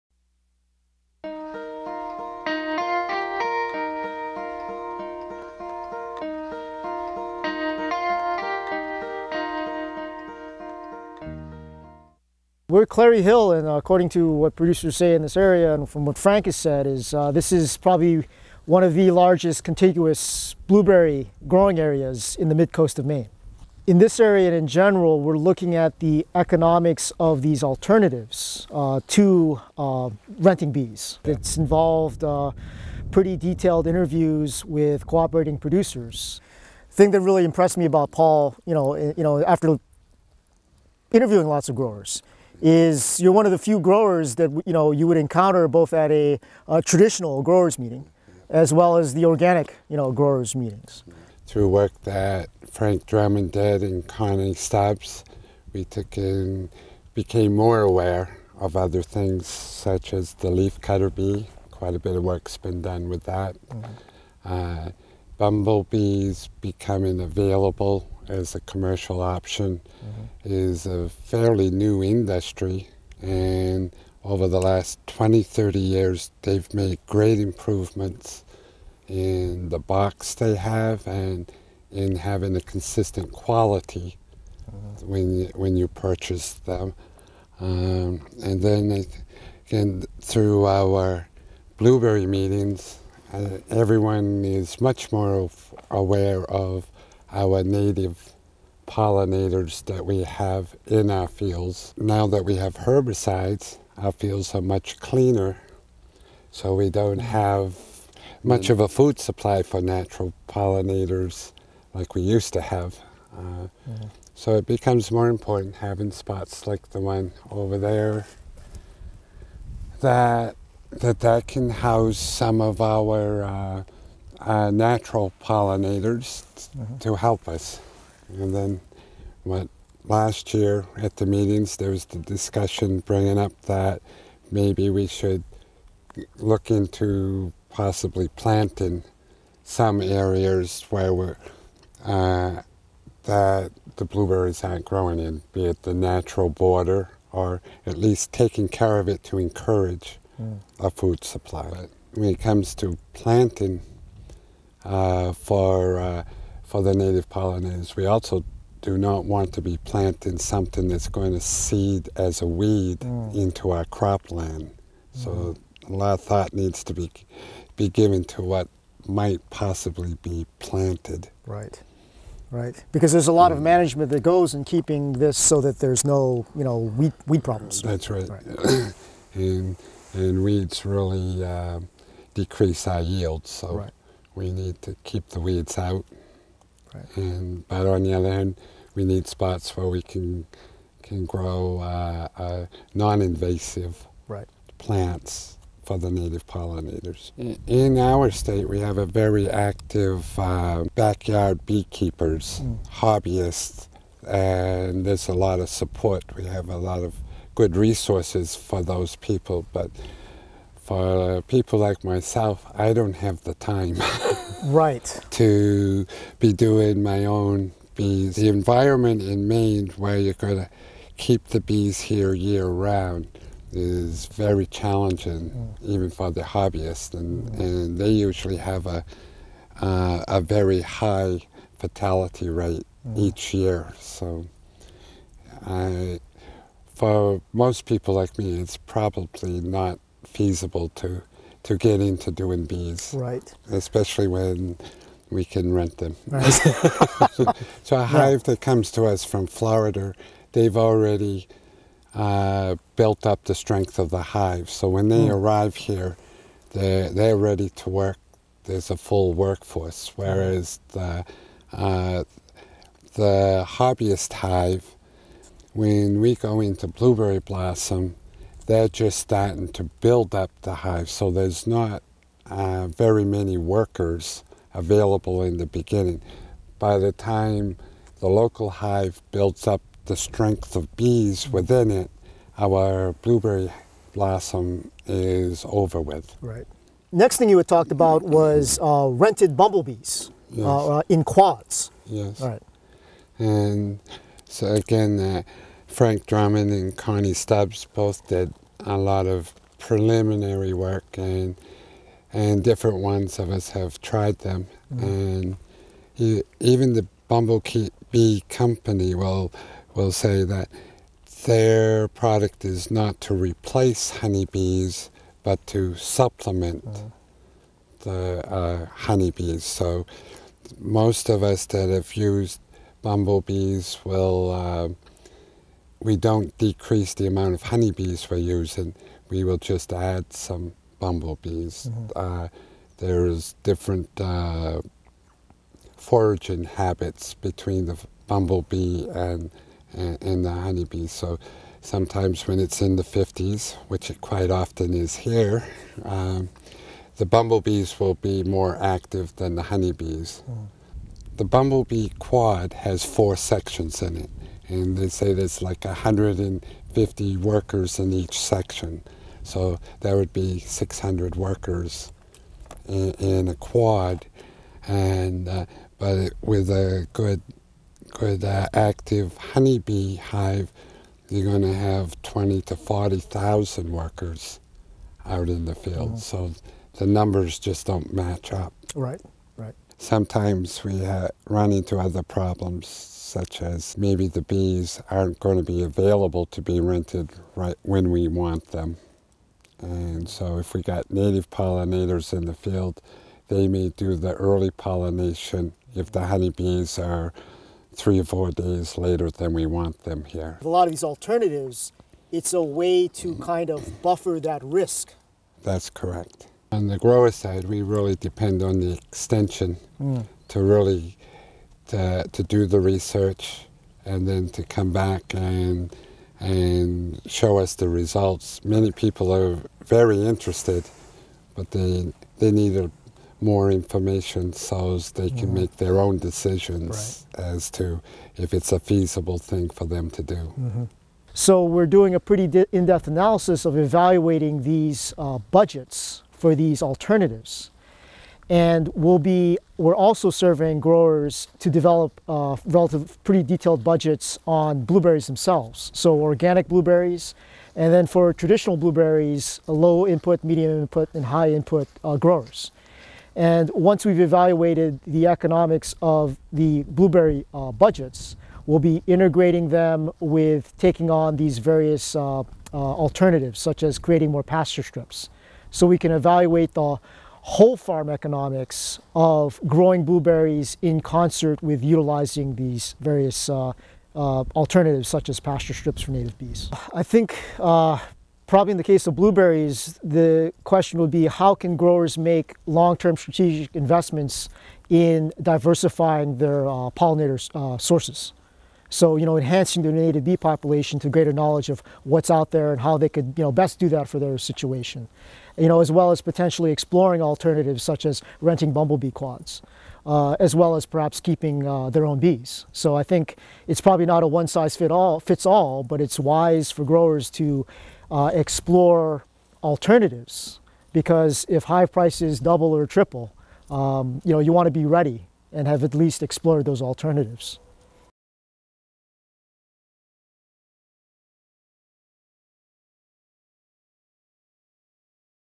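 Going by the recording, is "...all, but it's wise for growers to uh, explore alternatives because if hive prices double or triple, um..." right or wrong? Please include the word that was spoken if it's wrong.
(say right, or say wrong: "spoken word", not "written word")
right.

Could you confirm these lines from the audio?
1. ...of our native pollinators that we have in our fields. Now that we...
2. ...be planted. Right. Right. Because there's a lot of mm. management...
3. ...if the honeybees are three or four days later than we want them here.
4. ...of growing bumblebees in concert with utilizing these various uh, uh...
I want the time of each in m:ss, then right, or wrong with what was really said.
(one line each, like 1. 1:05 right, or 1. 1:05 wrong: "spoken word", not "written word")
1. 1:36 right
2. 2:50 right
3. 6:35 right
4. 7:49 wrong: "blueberries", not "bumblebees".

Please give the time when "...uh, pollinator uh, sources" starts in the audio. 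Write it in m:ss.
8:06.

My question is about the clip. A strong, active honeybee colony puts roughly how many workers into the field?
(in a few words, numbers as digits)
20,000 to 40,000.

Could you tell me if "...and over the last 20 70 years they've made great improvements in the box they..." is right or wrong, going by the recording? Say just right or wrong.
wrong.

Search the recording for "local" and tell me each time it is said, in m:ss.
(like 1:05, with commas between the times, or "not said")
4:38.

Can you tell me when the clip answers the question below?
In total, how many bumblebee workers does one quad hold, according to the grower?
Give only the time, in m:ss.
6:00.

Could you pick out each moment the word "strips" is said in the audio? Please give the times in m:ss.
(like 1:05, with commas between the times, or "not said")
7:44, 7:55.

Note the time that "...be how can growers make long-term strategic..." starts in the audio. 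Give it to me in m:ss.
8:01.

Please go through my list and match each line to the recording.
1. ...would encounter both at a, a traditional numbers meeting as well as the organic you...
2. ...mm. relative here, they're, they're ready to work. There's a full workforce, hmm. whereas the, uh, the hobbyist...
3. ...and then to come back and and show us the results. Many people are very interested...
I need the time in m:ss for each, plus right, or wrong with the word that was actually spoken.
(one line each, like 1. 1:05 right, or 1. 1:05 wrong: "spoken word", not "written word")
1. 0:45 wrong: "growers", not "numbers"
2. 4:15 wrong: "arrive", not "relative"
3. 6:54 right.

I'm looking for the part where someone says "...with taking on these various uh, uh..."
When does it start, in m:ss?
7:40.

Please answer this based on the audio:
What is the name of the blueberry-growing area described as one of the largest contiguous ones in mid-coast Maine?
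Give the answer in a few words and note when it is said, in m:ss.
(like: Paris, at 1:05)
Clarry Hill, at 0:12.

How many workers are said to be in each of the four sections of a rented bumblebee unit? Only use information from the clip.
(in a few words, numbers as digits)
150.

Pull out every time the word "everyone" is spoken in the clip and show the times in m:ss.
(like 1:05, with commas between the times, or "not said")
1:33.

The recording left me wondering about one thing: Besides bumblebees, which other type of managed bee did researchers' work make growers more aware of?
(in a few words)
leaf cutter bee.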